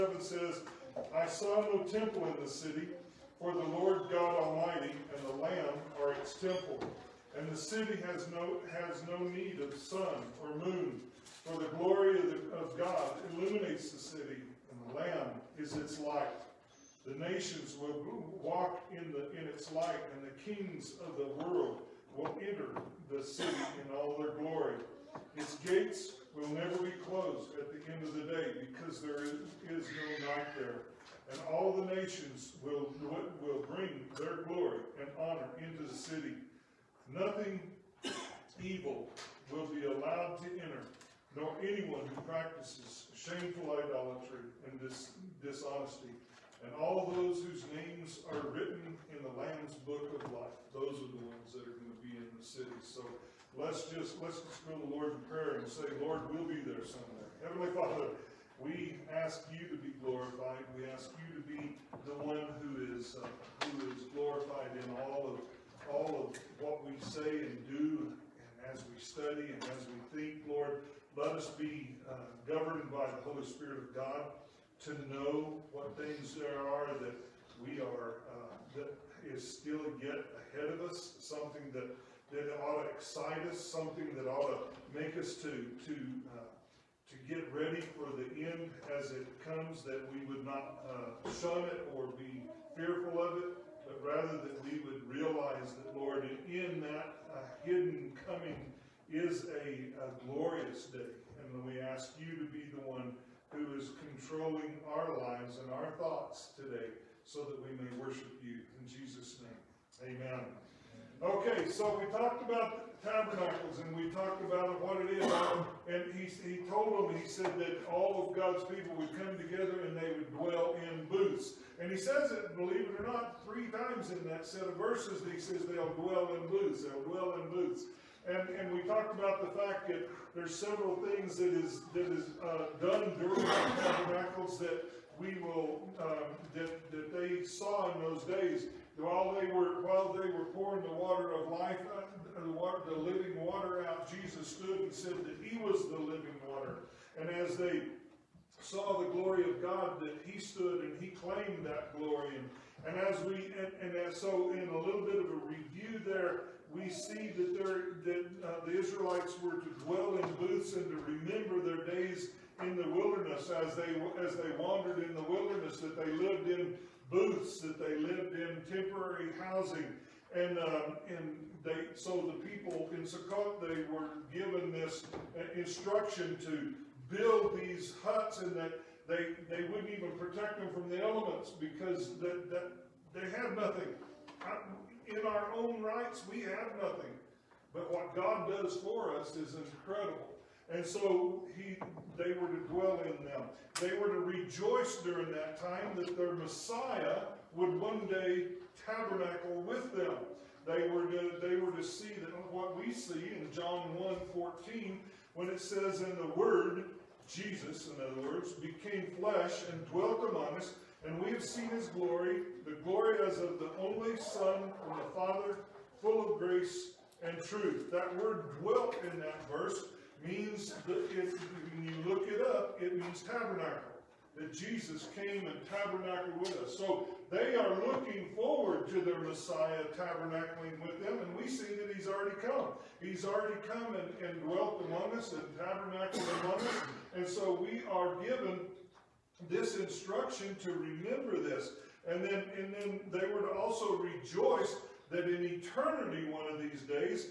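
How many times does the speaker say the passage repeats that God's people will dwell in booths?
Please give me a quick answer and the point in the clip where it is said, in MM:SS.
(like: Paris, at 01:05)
3, at 02:03.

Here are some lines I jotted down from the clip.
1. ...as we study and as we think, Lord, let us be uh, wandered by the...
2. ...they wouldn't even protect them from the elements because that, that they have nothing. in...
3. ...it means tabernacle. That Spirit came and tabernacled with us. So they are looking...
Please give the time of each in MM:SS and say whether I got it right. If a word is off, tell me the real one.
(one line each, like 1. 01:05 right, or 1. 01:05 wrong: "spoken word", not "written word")
1. 01:08 wrong: "governed", not "wandered"
2. 02:59 right
3. 03:42 wrong: "Jesus", not "Spirit".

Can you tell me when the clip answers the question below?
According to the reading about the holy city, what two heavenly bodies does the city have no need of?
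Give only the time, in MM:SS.
00:09.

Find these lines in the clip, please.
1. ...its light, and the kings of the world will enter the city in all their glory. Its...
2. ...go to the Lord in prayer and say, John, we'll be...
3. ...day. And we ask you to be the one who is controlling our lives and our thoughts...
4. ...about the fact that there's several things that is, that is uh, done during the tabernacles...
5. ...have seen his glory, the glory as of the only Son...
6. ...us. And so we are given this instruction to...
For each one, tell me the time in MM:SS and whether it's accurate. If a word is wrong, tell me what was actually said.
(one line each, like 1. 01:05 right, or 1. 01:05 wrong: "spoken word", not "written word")
1. 00:19 right
2. 00:54 wrong: "Lord", not "John"
3. 01:40 right
4. 02:09 right
5. 03:31 right
6. 03:56 right.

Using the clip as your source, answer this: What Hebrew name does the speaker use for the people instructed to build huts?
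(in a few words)
Sukkot.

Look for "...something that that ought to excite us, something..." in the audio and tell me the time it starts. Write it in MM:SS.
01:21.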